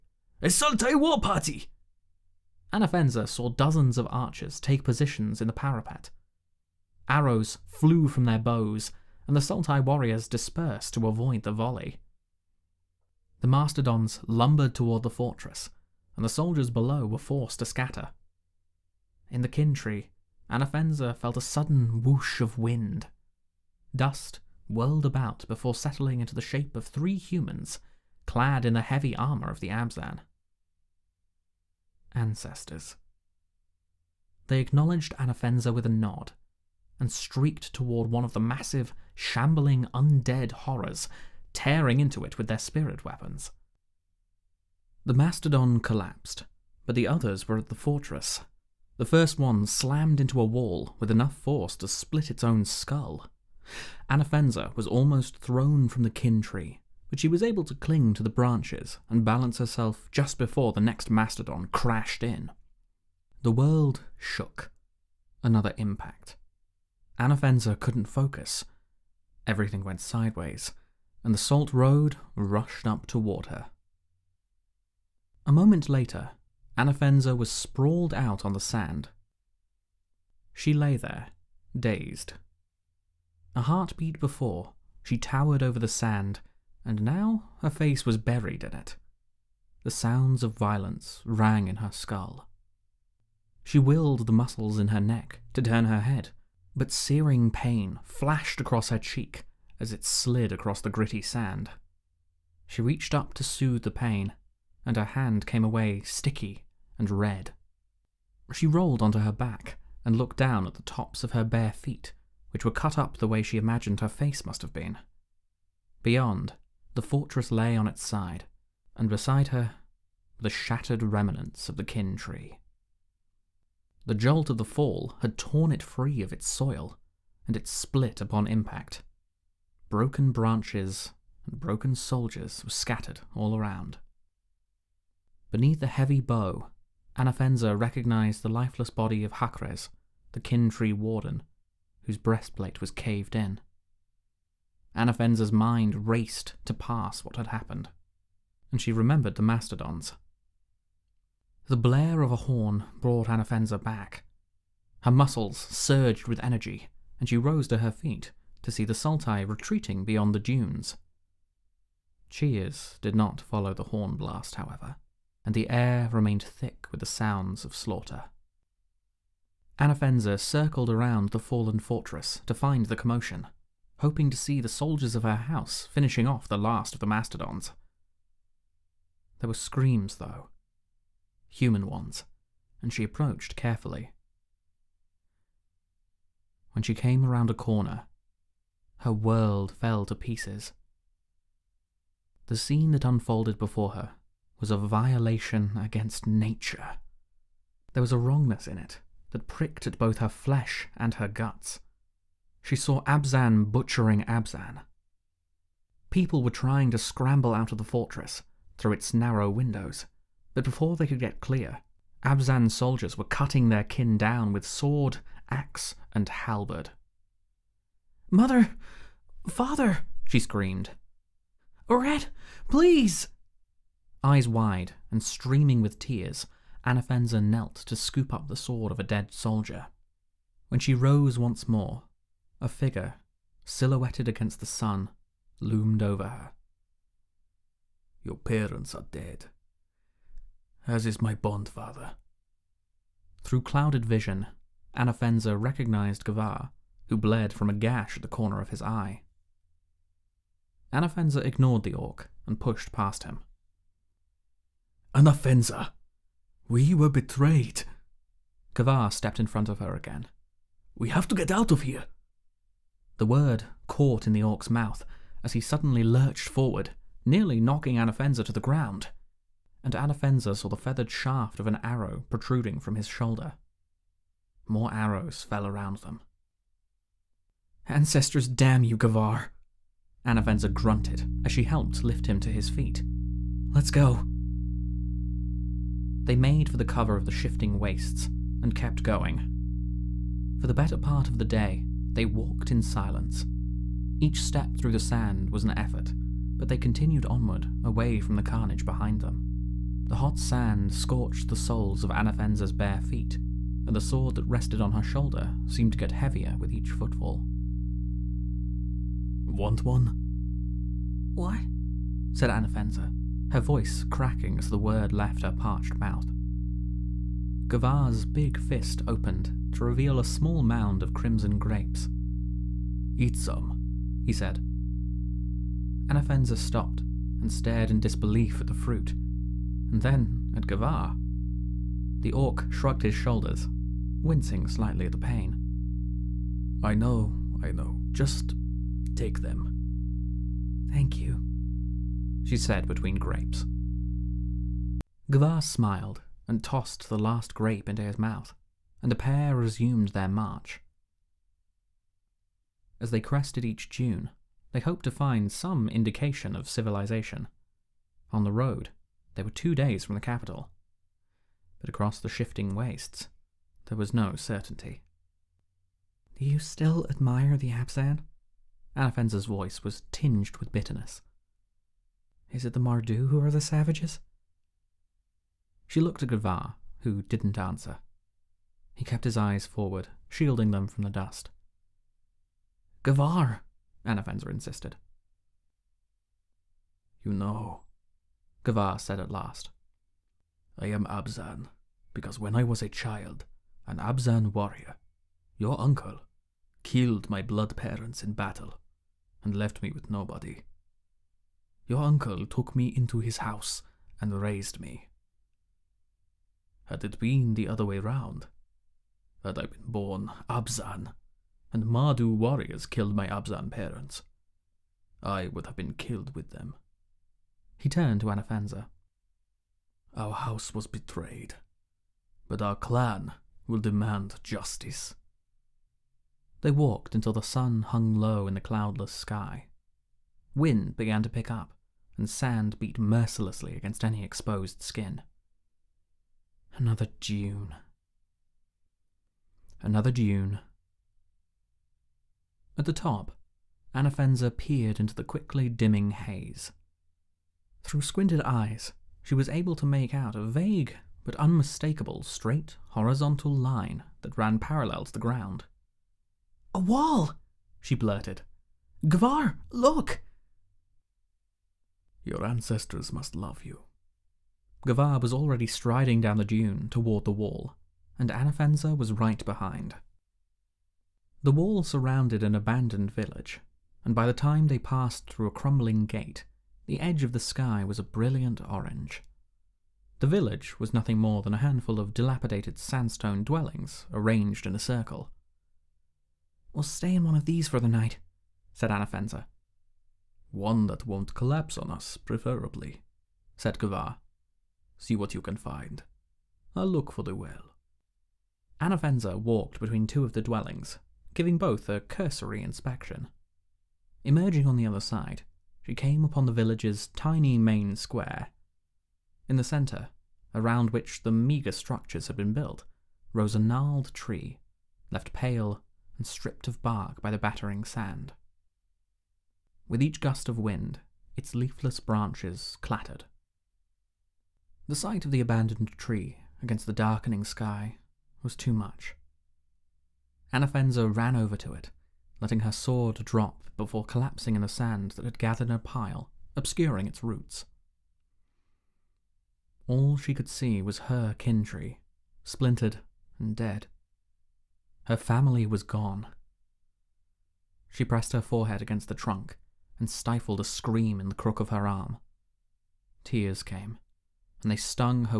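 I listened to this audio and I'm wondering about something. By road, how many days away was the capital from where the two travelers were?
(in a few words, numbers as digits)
2.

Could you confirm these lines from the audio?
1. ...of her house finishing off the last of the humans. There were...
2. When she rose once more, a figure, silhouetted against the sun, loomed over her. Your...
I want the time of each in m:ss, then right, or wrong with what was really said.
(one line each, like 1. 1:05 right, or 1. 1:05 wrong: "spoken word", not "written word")
1. 2:55 wrong: "mastodons", not "humans"
2. 3:50 right.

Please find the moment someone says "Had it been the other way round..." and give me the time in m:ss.
6:46.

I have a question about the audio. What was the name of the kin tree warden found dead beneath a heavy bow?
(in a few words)
Hakres.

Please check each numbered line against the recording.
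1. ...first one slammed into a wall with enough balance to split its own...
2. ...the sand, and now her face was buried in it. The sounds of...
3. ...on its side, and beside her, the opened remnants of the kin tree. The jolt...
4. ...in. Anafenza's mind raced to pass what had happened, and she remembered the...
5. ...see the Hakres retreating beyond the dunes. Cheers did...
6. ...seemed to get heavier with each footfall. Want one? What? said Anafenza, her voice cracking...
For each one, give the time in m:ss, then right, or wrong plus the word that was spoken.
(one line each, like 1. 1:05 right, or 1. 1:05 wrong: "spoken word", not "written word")
1. 0:49 wrong: "force", not "balance"
2. 1:25 right
3. 1:57 wrong: "shattered", not "opened"
4. 2:23 right
5. 2:38 wrong: "Sultai", not "Hakres"
6. 5:05 right.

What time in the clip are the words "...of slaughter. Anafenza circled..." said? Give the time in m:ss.
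2:47.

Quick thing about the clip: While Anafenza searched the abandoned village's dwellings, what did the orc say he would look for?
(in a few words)
The well.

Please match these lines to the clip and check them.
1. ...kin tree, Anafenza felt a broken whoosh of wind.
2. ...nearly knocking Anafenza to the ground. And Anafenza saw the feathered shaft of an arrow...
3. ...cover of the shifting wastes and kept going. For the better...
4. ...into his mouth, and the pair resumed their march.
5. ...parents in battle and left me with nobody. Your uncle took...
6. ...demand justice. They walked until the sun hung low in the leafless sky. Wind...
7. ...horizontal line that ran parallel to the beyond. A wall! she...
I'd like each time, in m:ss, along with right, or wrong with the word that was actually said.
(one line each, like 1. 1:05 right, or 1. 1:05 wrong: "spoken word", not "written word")
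1. 0:19 wrong: "sudden", not "broken"
2. 4:27 right
3. 4:46 right
4. 5:47 right
5. 6:37 right
6. 7:03 wrong: "cloudless", not "leafless"
7. 7:32 wrong: "ground", not "beyond".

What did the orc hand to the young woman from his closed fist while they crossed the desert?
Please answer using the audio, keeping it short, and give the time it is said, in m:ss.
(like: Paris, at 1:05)
Crimson grapes, at 5:21.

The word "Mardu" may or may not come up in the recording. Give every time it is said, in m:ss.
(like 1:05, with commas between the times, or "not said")
6:12, 6:51.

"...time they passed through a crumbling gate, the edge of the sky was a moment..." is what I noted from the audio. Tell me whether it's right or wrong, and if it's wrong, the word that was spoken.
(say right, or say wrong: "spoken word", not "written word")
wrong: "brilliant", not "moment".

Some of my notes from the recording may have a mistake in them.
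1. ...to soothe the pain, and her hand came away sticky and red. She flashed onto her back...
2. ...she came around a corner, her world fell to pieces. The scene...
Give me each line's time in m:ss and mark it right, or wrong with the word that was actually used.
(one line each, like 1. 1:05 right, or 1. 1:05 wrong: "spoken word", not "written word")
1. 1:43 wrong: "rolled", not "flashed"
2. 3:06 right.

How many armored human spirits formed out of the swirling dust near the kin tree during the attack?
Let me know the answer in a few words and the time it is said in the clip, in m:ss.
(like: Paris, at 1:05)
3, at 0:26.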